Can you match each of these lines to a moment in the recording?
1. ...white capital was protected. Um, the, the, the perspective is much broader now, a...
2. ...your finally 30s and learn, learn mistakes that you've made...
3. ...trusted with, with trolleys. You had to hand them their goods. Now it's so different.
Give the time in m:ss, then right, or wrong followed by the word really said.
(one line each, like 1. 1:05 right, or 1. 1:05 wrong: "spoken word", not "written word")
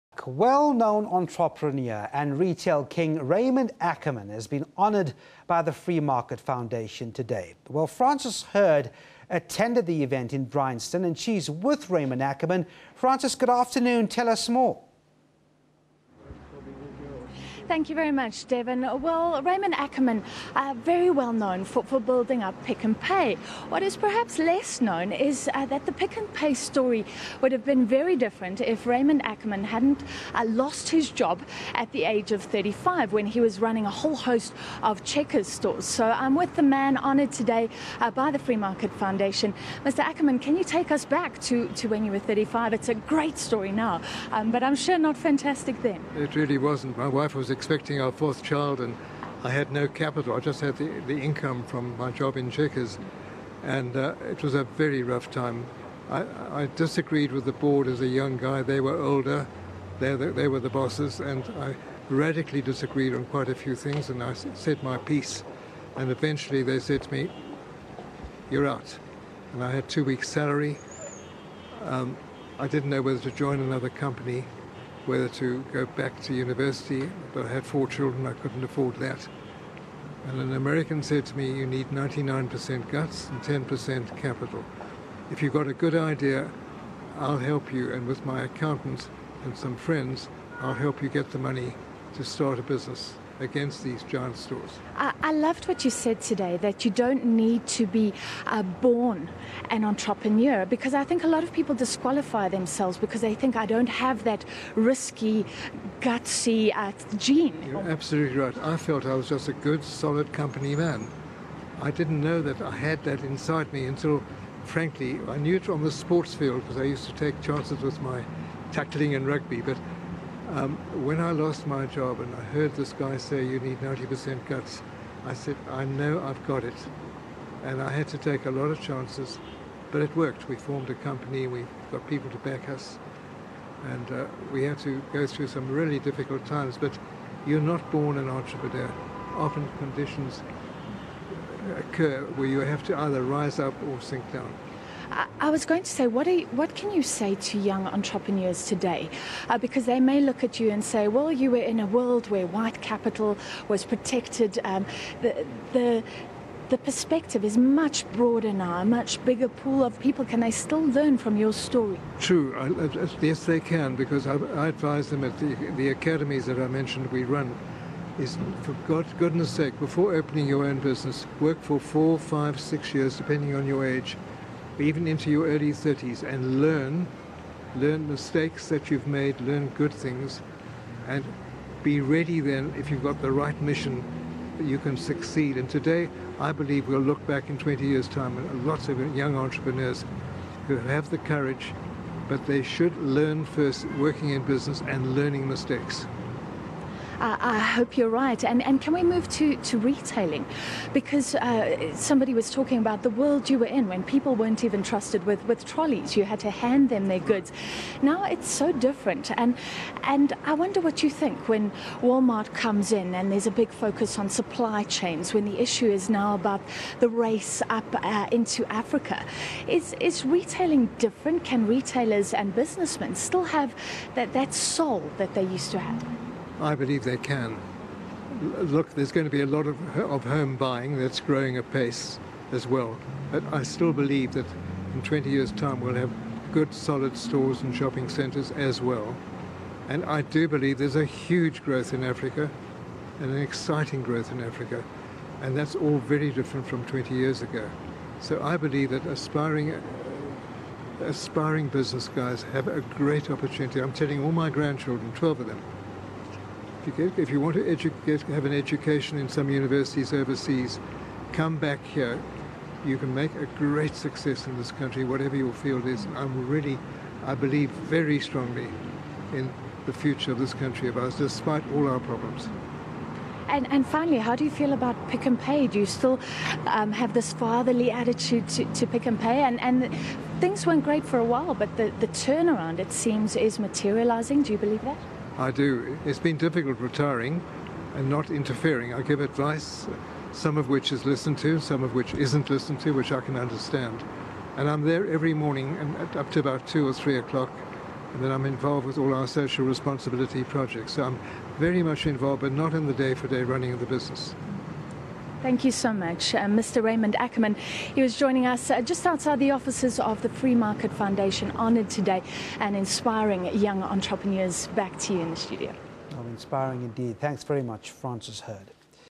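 1. 2:32 right
2. 2:55 wrong: "early", not "finally"
3. 3:24 right.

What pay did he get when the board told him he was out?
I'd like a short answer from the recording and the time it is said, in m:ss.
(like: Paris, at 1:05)
Two weeks' salary, at 1:09.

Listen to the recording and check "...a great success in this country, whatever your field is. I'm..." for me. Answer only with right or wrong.
right.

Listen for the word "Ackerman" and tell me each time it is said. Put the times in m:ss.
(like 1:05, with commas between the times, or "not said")
0:03, 0:12, 0:19, 0:29, 0:39, 5:07.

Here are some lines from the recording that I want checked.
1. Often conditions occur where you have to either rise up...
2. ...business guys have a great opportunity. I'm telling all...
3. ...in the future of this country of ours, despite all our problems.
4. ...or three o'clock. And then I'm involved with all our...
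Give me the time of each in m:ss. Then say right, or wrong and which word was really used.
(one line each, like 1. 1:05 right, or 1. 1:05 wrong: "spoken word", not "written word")
1. 2:19 right
2. 4:11 right
3. 4:29 right
4. 4:56 right.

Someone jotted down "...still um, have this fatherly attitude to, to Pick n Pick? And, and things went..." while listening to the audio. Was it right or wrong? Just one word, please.
wrong.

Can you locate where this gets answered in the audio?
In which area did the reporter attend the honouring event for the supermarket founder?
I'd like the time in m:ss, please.
0:10.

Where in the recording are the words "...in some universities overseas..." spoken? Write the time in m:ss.
4:19.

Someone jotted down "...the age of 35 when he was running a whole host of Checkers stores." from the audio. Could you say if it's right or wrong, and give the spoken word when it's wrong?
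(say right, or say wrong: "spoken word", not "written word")
right.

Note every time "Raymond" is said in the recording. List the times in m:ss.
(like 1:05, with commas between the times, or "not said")
0:03, 0:11, 0:19, 0:28, 5:06.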